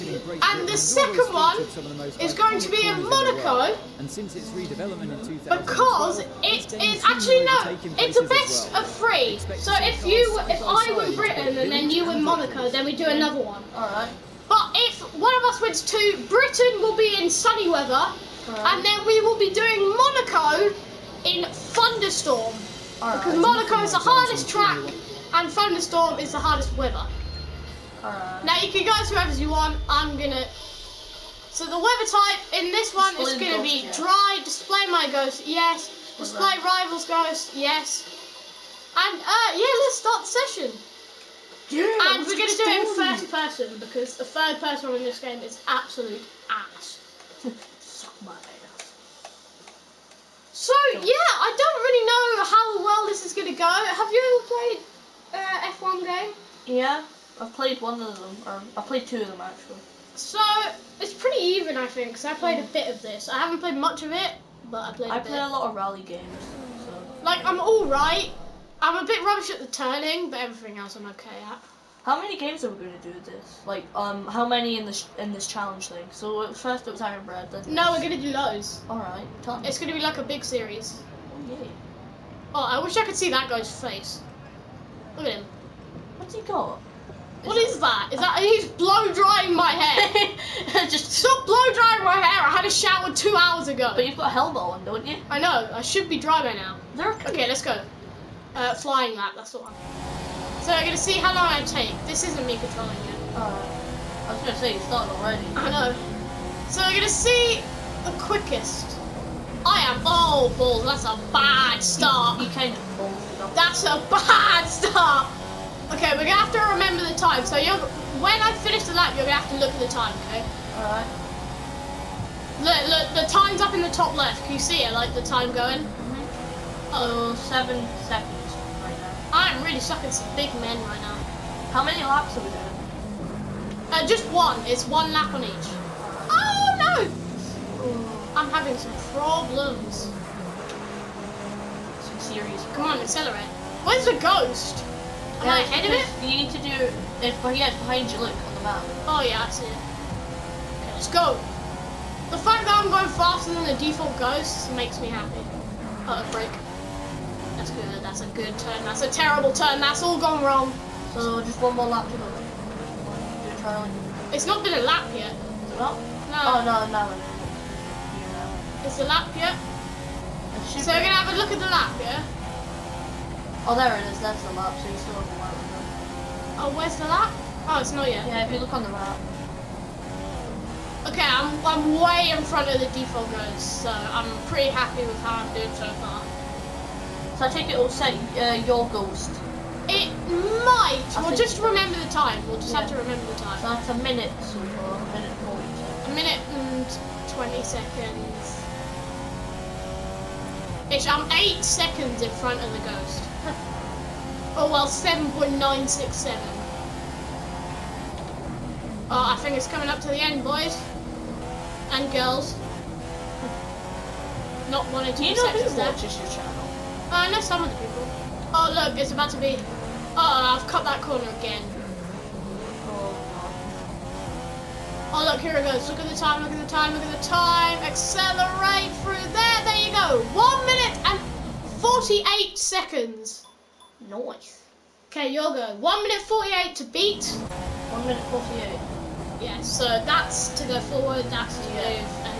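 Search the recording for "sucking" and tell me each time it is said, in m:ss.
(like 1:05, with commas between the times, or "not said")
2:09.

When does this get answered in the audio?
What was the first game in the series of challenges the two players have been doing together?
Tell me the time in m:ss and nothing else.
1:17.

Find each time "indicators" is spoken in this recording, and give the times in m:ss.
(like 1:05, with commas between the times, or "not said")
not said.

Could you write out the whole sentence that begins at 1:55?
Okay, we're gonna have to remember the time.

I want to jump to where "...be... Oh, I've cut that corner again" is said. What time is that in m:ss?
3:39.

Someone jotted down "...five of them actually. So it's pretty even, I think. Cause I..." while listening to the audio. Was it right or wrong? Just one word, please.
wrong.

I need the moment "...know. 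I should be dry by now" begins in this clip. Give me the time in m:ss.
1:35.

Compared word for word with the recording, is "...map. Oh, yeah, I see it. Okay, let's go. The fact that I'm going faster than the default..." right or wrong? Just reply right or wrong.
right.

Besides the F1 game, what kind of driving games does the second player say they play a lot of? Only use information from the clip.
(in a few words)
rally games.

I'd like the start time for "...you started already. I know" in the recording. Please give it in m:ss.
1:44.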